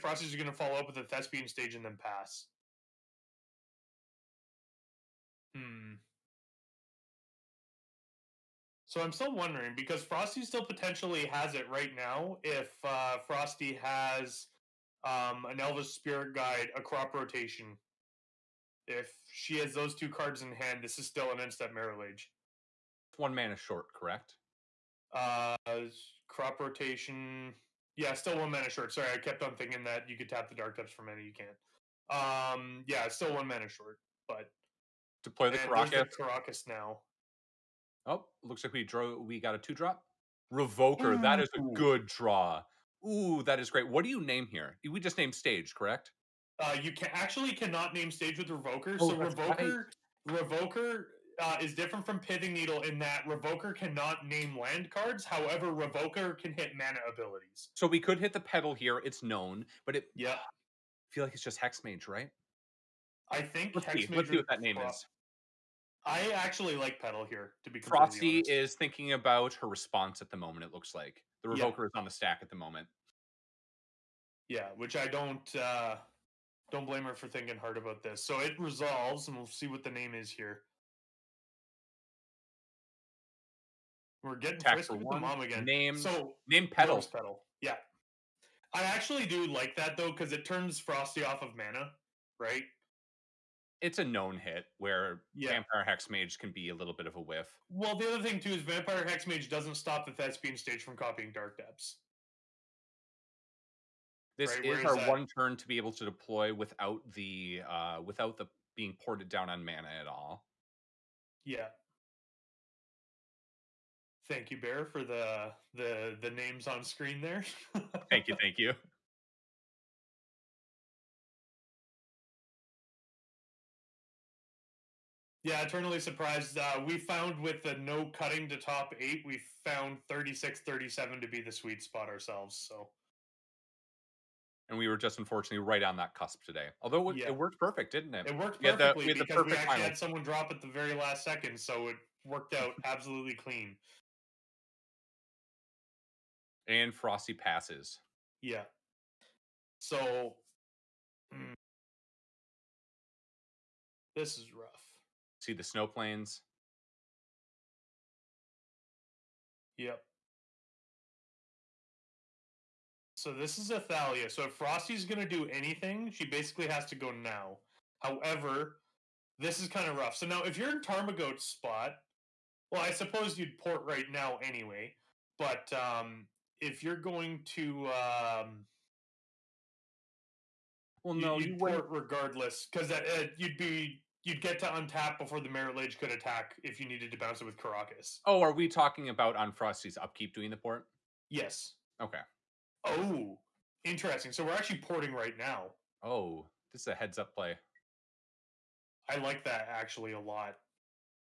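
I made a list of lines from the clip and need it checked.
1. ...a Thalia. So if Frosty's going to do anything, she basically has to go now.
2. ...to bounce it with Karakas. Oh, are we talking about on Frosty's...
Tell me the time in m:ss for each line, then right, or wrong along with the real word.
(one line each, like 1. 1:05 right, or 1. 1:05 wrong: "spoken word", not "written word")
1. 2:43 right
2. 3:07 right.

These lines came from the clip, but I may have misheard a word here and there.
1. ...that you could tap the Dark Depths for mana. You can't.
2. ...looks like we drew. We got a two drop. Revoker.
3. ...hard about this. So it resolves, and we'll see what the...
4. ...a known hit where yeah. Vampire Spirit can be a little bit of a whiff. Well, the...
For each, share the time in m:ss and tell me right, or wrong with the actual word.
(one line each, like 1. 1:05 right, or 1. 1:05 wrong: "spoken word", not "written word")
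1. 0:29 right
2. 0:38 right
3. 1:17 right
4. 1:33 wrong: "Hexmage", not "Spirit".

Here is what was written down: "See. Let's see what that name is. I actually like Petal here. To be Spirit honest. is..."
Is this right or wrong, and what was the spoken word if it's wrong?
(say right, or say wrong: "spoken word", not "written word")
wrong: "Frosty", not "Spirit".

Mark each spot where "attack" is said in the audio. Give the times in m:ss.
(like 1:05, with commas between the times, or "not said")
1:24, 3:06.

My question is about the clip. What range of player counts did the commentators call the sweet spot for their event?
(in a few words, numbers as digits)
36 to 37.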